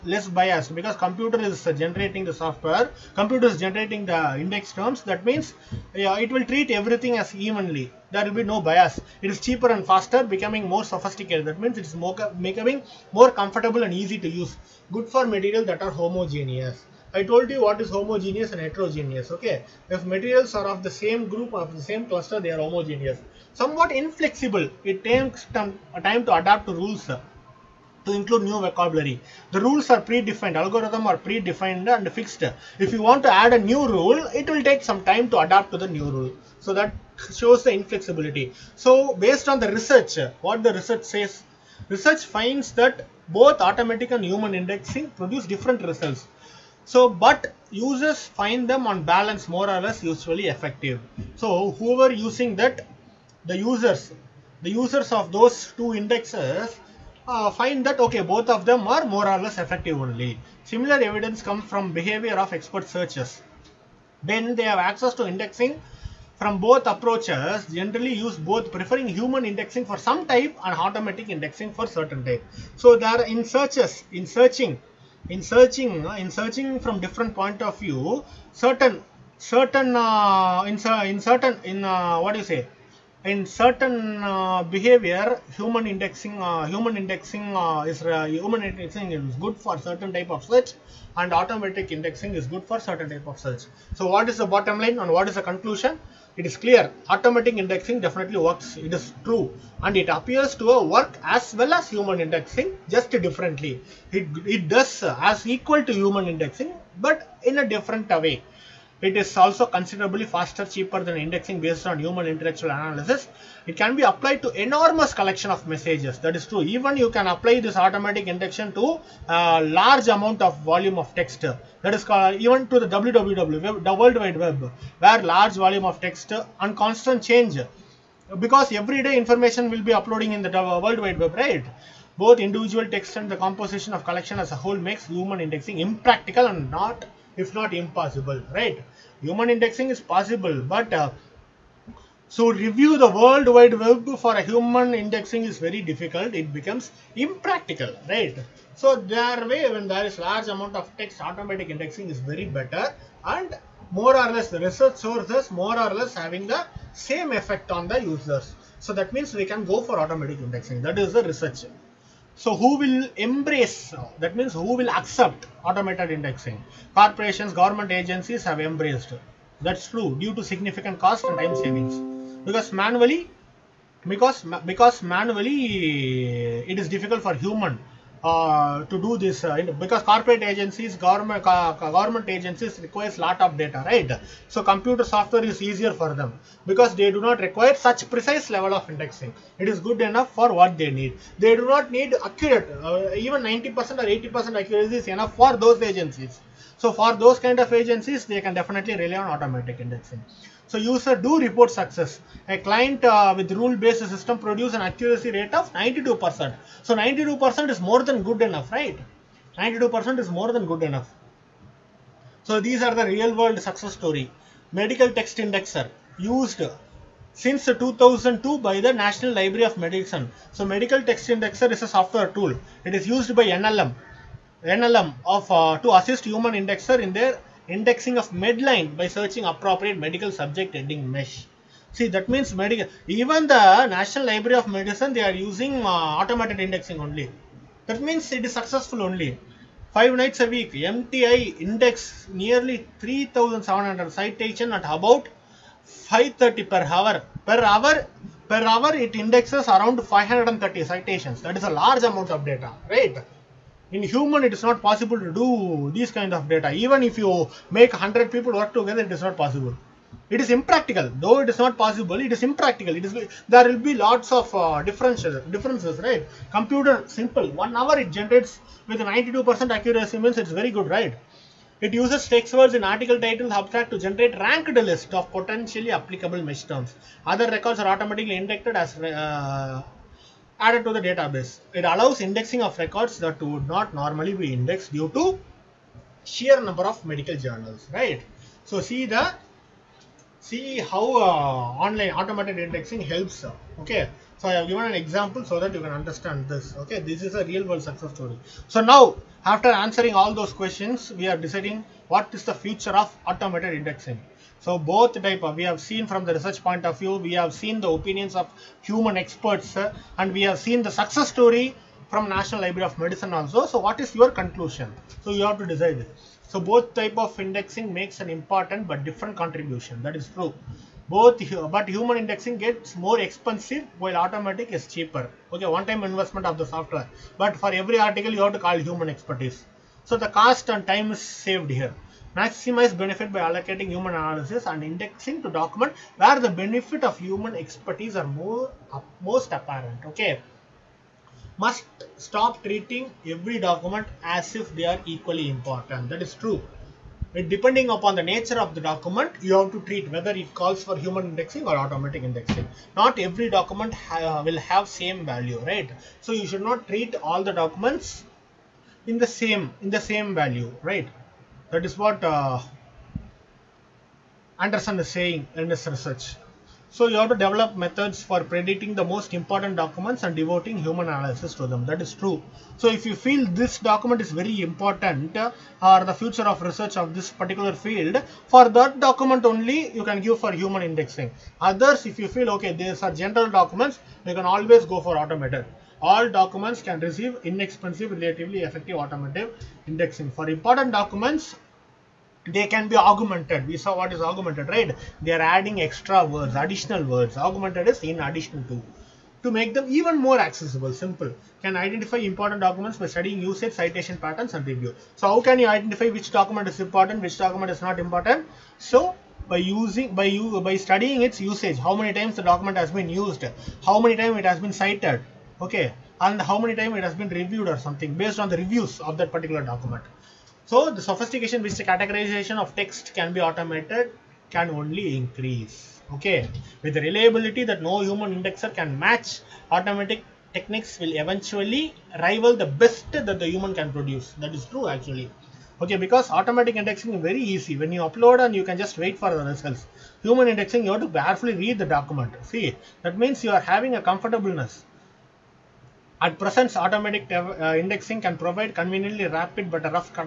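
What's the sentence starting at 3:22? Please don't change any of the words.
A client uh, with rule-based system produce an accuracy rate of 92%.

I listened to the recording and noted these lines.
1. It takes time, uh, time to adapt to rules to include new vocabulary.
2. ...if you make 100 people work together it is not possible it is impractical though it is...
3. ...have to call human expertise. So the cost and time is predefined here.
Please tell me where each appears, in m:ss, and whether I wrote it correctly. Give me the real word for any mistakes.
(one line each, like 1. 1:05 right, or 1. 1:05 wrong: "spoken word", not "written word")
1. 0:24 right
2. 4:17 right
3. 5:28 wrong: "saved", not "predefined".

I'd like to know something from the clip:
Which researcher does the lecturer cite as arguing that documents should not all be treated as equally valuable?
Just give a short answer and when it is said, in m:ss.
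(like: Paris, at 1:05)
Anderson, at 6:04.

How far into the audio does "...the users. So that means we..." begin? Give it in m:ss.
2:37.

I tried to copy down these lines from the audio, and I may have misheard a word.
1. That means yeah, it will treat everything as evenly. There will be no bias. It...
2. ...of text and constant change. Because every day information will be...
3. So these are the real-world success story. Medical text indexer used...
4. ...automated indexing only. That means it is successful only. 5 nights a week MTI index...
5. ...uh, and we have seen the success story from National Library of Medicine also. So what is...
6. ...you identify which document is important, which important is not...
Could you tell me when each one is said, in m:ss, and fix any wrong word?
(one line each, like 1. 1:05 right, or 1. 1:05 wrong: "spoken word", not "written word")
1. 0:05 right
2. 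2:05 right
3. 3:32 right
4. 3:56 right
5. 5:09 right
6. 6:45 wrong: "document", not "important".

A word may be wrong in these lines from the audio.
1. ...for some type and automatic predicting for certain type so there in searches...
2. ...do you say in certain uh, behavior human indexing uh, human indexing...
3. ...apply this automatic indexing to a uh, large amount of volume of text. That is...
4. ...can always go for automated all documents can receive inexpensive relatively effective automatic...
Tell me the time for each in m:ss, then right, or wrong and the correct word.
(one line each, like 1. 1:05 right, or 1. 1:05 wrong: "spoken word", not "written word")
1. 1:09 wrong: "indexing", not "predicting"
2. 1:22 right
3. 1:57 right
4. 6:24 right.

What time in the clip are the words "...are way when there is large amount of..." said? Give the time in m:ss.
2:28.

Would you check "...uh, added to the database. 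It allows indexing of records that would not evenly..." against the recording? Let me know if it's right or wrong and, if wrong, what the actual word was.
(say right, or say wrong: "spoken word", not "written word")
wrong: "normally", not "evenly".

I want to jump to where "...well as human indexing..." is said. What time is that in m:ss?
1:41.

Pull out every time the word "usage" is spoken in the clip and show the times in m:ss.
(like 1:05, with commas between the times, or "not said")
6:43, 6:51.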